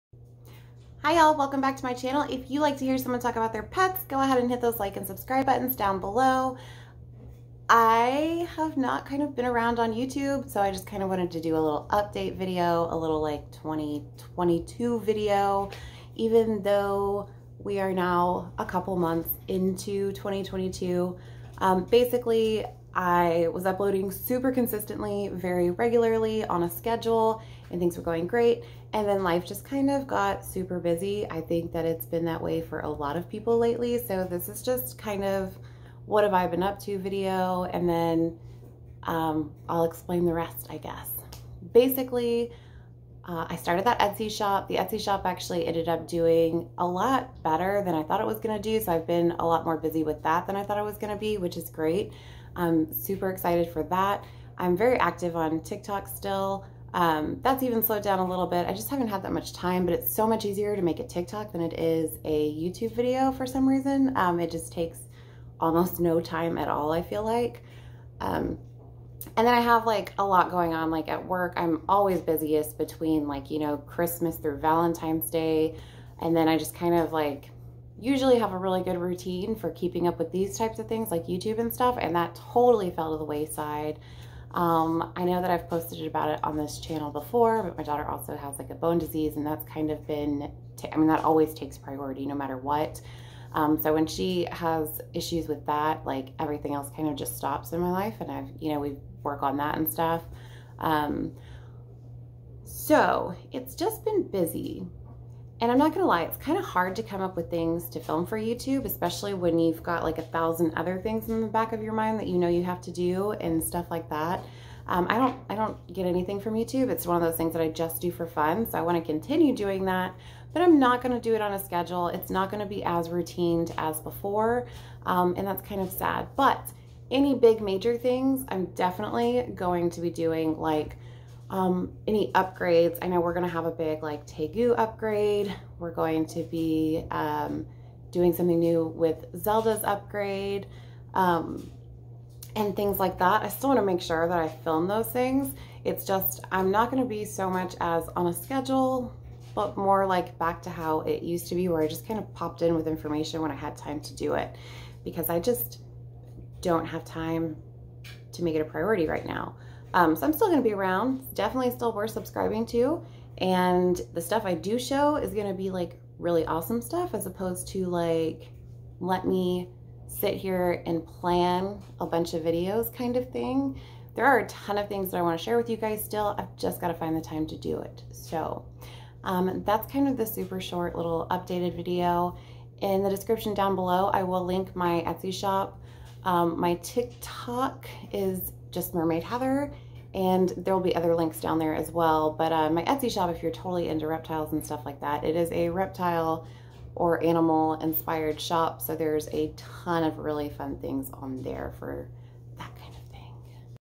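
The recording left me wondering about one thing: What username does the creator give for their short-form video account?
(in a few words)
Mermaid Heather.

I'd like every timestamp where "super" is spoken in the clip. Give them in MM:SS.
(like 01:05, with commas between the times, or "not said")
00:24, 00:30, 00:52, 03:00.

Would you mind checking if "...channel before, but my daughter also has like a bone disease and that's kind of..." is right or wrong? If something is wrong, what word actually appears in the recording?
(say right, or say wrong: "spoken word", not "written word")
right.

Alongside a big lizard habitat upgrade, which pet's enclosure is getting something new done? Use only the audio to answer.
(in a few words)
Zelda.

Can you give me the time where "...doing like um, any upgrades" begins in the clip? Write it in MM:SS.
02:10.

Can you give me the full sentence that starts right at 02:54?
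There are a ton of things that I want to share with you guys still.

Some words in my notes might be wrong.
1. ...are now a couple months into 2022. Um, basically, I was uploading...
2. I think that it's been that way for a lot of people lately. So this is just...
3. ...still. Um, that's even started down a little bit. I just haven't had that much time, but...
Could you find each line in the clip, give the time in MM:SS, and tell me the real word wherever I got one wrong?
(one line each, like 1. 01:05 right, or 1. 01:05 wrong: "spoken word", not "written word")
1. 00:17 right
2. 00:31 right
3. 00:56 wrong: "slowed", not "started".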